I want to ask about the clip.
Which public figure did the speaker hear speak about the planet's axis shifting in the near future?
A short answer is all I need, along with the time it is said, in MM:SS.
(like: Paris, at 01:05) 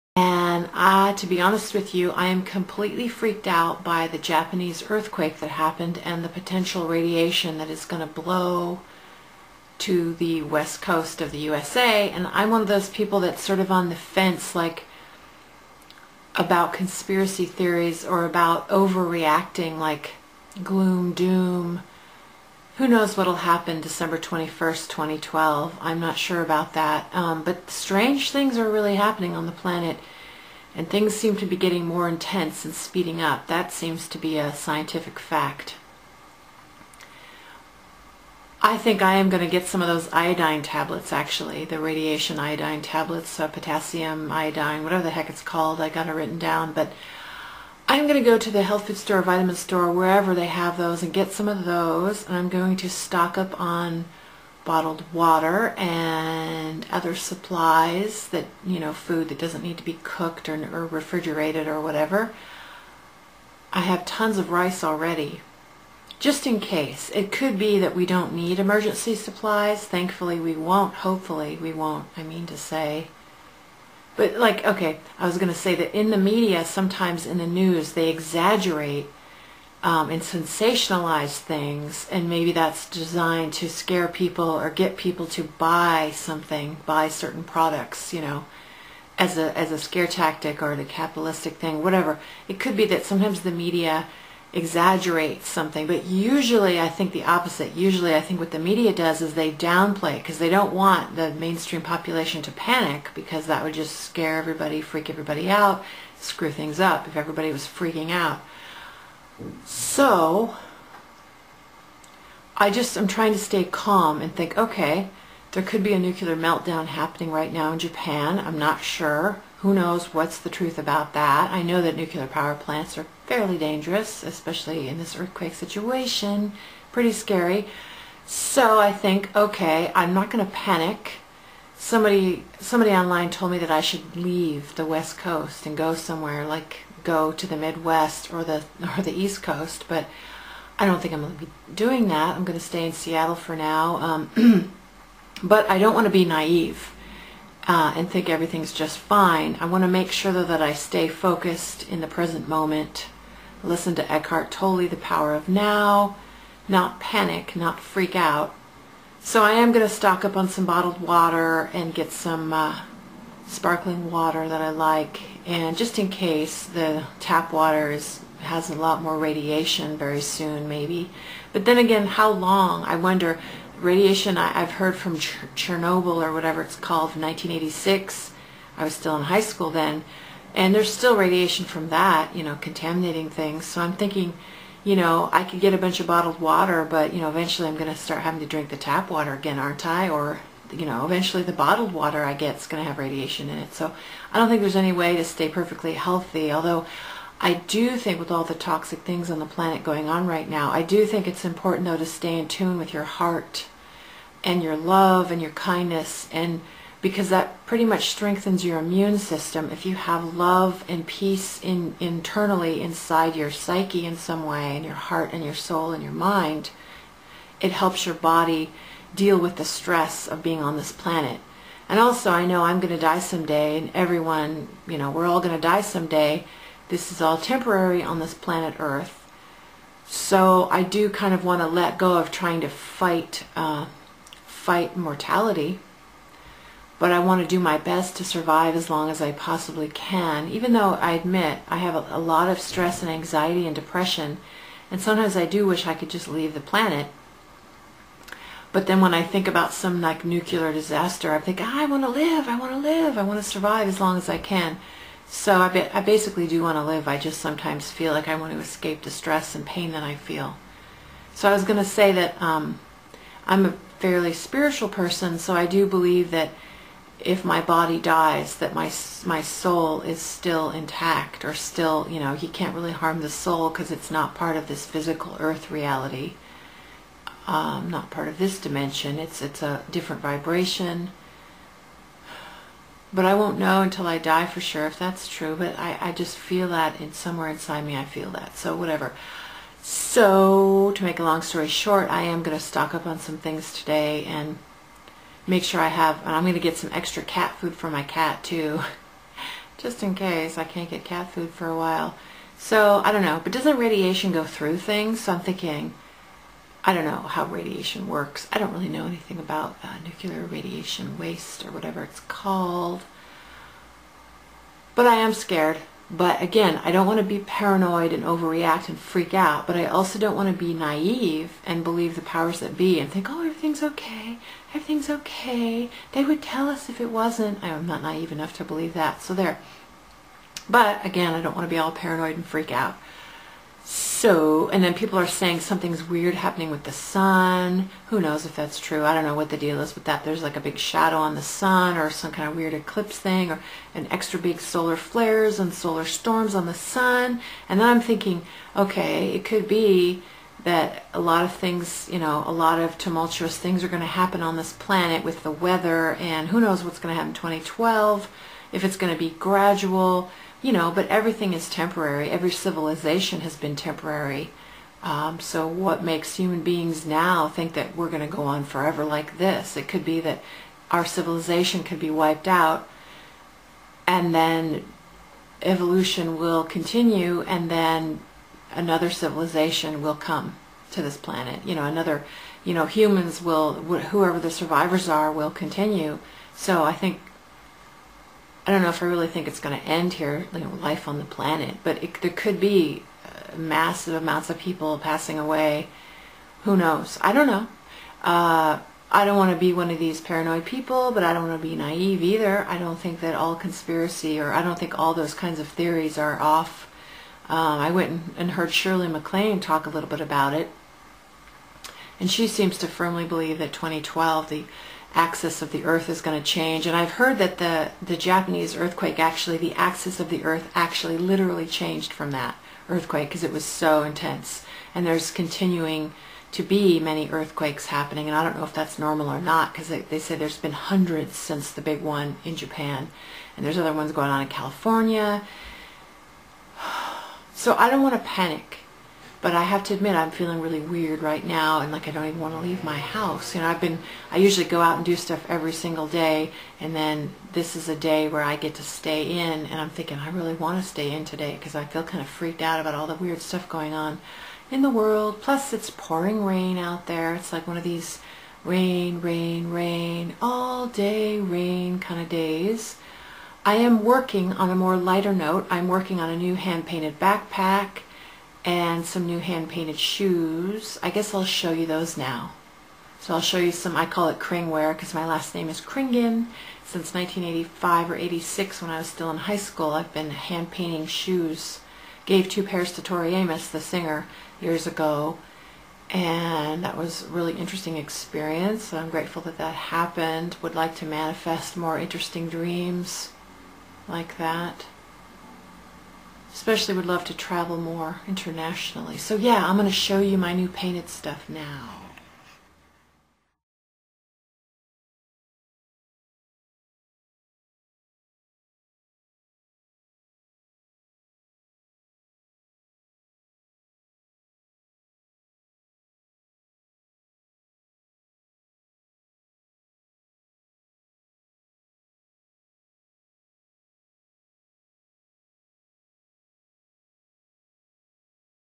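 Shirley MacLaine, at 06:48.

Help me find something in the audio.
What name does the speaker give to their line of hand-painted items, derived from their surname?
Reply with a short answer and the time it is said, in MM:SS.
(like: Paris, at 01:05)
Kringware, at 07:54.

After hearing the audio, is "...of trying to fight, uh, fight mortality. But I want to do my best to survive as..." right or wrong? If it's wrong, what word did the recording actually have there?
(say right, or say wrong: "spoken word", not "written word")
right.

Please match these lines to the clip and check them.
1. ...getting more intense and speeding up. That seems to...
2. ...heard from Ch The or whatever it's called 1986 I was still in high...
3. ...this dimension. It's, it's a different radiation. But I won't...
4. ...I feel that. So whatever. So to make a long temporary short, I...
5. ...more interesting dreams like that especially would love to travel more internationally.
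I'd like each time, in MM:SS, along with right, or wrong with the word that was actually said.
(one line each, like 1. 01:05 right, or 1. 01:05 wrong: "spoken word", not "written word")
1. 00:31 right
2. 02:54 wrong: "Chernobyl", not "The"
3. 04:38 wrong: "vibration", not "radiation"
4. 04:47 wrong: "story", not "temporary"
5. 08:11 right.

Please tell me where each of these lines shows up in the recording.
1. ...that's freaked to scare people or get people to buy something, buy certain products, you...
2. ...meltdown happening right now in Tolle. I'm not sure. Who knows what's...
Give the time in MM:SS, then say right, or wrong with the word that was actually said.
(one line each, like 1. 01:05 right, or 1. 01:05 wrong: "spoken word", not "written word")
1. 01:22 wrong: "designed", not "freaked"
2. 01:56 wrong: "Japan", not "Tolle".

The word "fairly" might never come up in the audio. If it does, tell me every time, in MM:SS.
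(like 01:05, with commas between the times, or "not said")
02:03, 04:23.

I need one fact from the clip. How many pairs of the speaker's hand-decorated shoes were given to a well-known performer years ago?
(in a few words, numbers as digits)
2.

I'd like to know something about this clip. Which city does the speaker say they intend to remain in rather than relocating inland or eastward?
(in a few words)
Seattle.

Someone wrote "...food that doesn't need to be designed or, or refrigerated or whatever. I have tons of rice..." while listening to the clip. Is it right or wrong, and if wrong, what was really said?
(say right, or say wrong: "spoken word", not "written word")
wrong: "cooked", not "designed".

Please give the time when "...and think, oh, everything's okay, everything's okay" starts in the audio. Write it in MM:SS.
05:22.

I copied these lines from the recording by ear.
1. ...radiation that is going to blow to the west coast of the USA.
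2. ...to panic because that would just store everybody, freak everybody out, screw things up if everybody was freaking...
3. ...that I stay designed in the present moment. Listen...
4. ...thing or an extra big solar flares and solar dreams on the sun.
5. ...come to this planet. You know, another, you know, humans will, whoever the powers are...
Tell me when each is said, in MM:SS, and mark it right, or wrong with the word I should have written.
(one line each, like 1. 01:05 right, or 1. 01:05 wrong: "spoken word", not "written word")
1. 00:06 right
2. 01:42 wrong: "scare", not "store"
3. 02:30 wrong: "focused", not "designed"
4. 05:43 wrong: "storms", not "dreams"
5. 06:20 wrong: "survivors", not "powers".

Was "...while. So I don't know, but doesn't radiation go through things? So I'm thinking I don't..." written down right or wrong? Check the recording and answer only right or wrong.
right.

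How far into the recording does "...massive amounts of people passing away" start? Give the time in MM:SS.
06:33.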